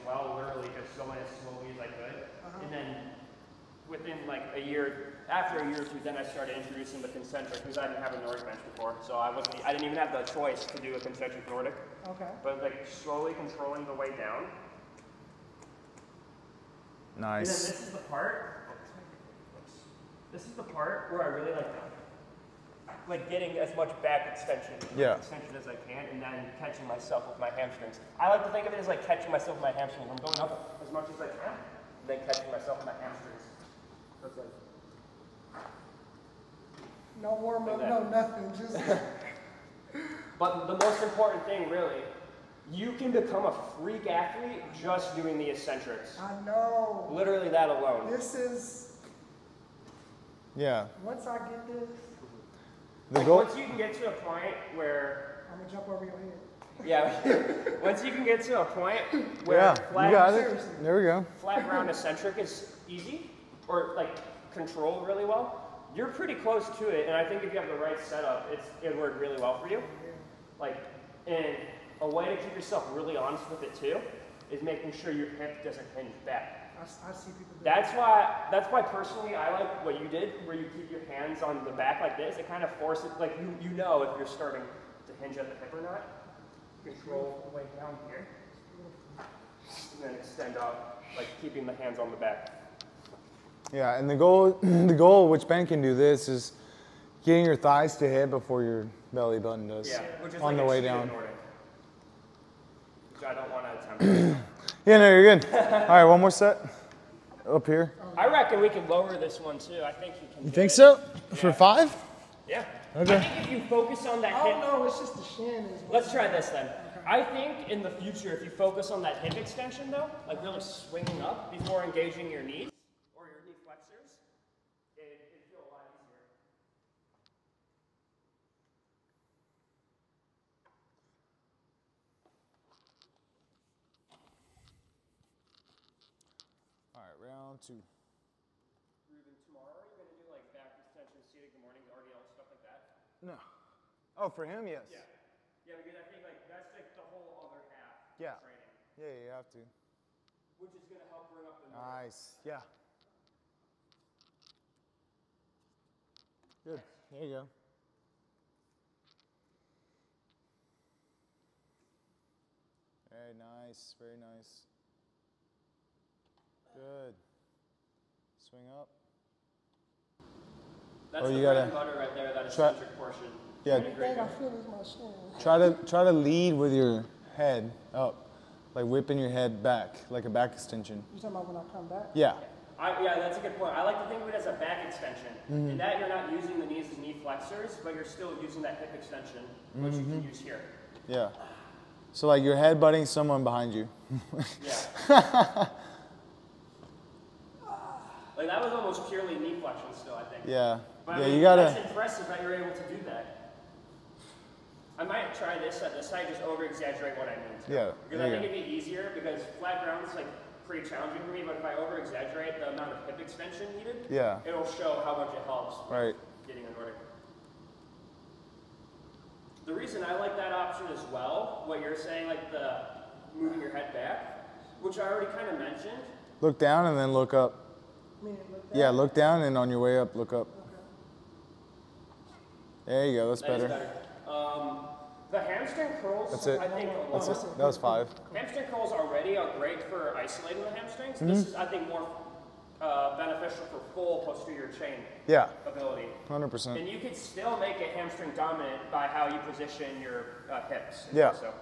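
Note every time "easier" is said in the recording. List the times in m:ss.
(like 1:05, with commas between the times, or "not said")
2:05, 3:28.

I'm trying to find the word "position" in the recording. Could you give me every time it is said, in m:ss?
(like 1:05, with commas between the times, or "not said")
4:09.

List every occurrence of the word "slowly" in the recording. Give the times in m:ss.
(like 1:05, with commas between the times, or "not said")
0:01, 0:12.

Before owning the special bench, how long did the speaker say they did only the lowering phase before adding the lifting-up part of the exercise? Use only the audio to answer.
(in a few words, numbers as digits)
a year or two.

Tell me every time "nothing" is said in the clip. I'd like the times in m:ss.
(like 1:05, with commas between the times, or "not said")
0:38.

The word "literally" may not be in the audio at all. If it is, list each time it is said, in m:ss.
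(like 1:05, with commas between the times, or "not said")
0:00, 0:47.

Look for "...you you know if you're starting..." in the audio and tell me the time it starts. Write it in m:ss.
1:23.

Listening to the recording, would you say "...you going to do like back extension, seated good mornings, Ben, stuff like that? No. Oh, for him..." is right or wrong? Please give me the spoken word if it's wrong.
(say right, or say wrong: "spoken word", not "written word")
wrong: "RDL", not "Ben".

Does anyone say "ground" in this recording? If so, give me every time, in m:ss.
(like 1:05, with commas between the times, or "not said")
1:01, 3:29.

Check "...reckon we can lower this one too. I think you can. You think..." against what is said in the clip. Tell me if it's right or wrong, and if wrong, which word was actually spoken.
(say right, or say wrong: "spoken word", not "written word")
right.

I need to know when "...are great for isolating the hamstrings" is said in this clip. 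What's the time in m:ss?
3:59.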